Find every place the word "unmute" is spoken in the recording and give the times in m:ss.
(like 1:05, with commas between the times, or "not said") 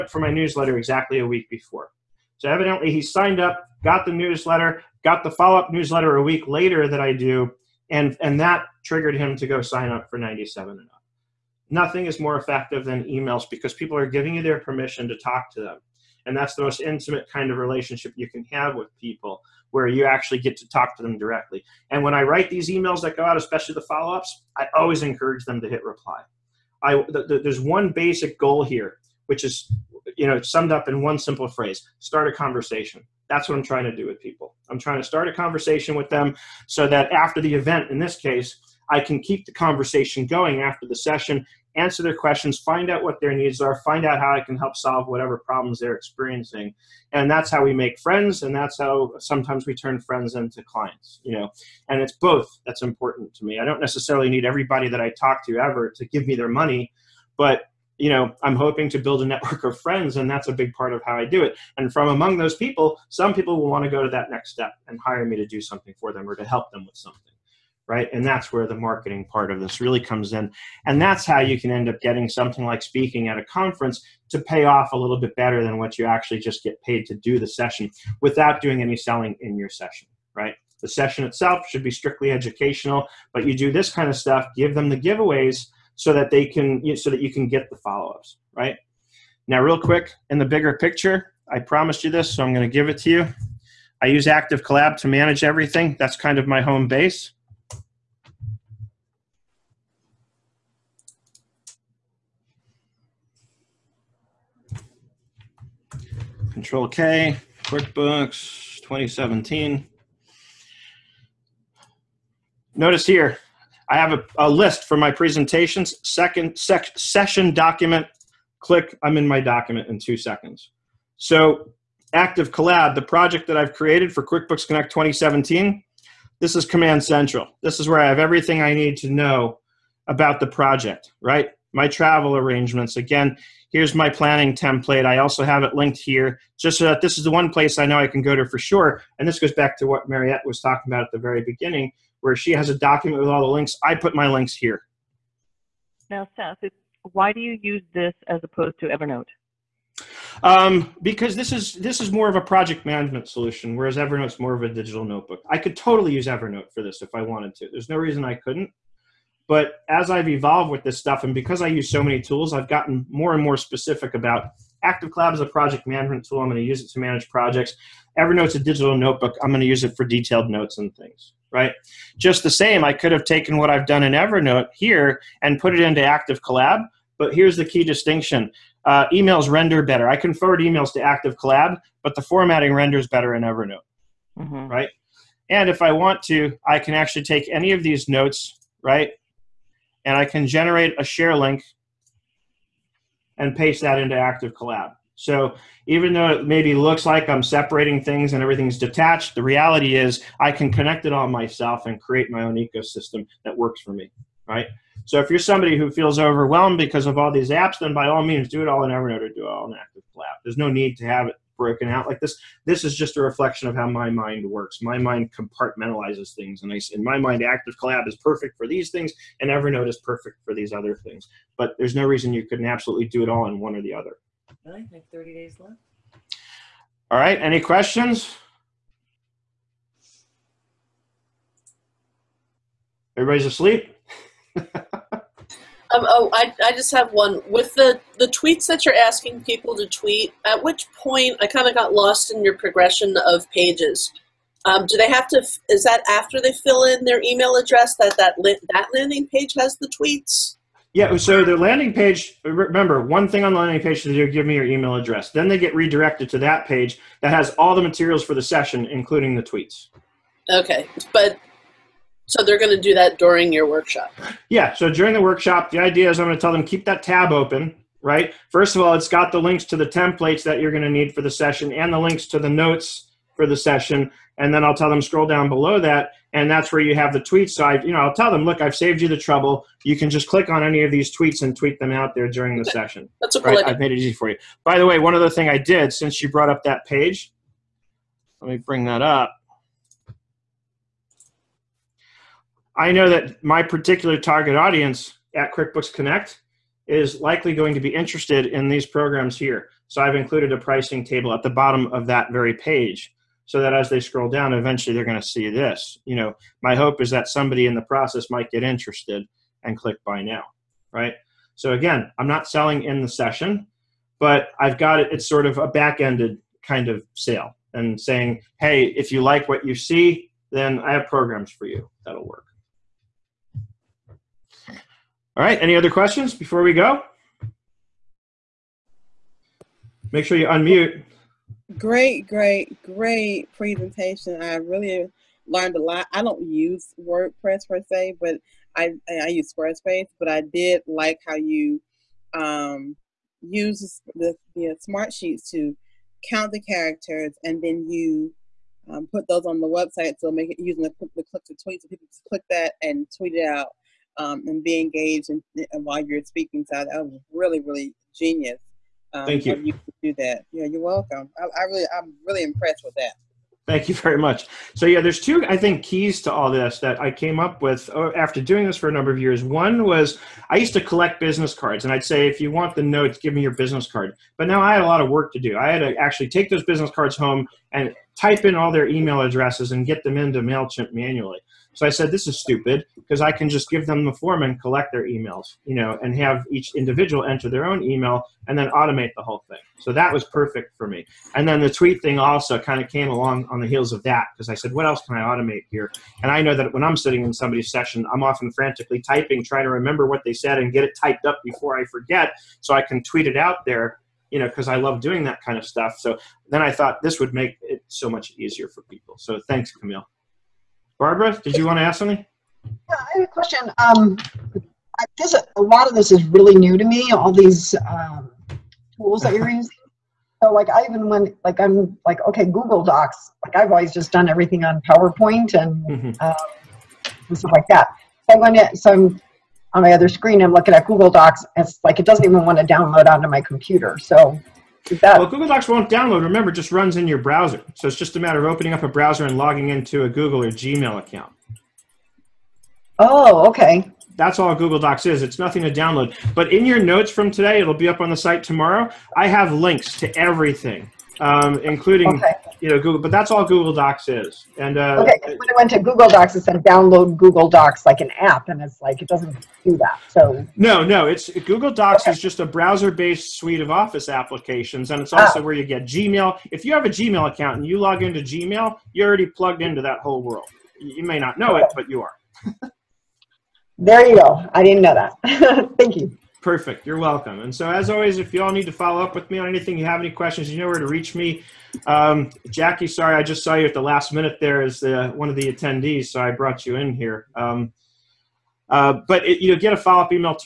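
5:30.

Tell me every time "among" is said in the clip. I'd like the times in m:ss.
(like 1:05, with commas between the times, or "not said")
1:02.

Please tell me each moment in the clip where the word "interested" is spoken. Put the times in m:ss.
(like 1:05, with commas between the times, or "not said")
4:57, 5:08.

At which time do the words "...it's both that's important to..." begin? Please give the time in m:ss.
0:52.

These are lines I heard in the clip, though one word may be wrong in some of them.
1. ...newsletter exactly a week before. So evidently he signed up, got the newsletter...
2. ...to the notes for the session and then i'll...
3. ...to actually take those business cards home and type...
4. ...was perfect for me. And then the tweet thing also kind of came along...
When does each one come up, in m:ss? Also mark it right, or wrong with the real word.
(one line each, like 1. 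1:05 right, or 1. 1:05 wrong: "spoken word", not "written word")
1. 0:00 right
2. 4:32 right
3. 6:15 right
4. 6:30 right.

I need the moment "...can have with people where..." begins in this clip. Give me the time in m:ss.
0:18.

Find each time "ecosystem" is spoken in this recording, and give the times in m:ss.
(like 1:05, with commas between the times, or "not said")
3:22.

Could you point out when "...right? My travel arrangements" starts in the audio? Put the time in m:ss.
2:11.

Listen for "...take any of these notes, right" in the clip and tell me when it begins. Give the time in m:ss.
3:07.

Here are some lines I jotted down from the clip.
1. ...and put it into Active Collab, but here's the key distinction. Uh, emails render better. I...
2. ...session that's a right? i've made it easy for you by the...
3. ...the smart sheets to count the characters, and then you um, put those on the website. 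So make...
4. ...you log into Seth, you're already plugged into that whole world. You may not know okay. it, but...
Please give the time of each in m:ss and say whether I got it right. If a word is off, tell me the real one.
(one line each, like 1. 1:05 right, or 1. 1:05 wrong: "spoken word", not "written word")
1. 2:55 right
2. 4:42 right
3. 5:44 right
4. 7:47 wrong: "Gmail", not "Seth".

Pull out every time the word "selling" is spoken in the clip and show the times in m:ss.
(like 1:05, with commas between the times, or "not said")
1:18, 5:12.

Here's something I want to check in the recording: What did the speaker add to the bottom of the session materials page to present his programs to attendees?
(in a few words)
A pricing table.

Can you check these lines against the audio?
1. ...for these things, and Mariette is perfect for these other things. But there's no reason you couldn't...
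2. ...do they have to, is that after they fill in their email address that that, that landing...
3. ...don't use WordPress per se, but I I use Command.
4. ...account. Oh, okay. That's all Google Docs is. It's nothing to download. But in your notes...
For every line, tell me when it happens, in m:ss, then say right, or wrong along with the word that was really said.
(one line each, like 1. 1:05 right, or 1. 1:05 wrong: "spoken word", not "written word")
1. 3:38 wrong: "Evernote", not "Mariette"
2. 4:04 right
3. 5:36 wrong: "Squarespace", not "Command"
4. 7:20 right.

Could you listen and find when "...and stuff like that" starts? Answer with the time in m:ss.
7:07.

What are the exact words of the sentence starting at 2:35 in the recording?
I could totally use Evernote for this if I wanted to.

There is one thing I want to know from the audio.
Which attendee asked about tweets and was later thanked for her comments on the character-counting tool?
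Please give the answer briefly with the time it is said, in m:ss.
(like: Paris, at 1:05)
Camille, at 6:49.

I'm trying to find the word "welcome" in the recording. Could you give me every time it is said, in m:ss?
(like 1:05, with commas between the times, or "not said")
6:00, 7:56.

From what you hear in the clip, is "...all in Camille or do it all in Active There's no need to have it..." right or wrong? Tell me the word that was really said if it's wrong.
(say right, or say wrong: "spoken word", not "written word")
wrong: "Evernote", not "Camille".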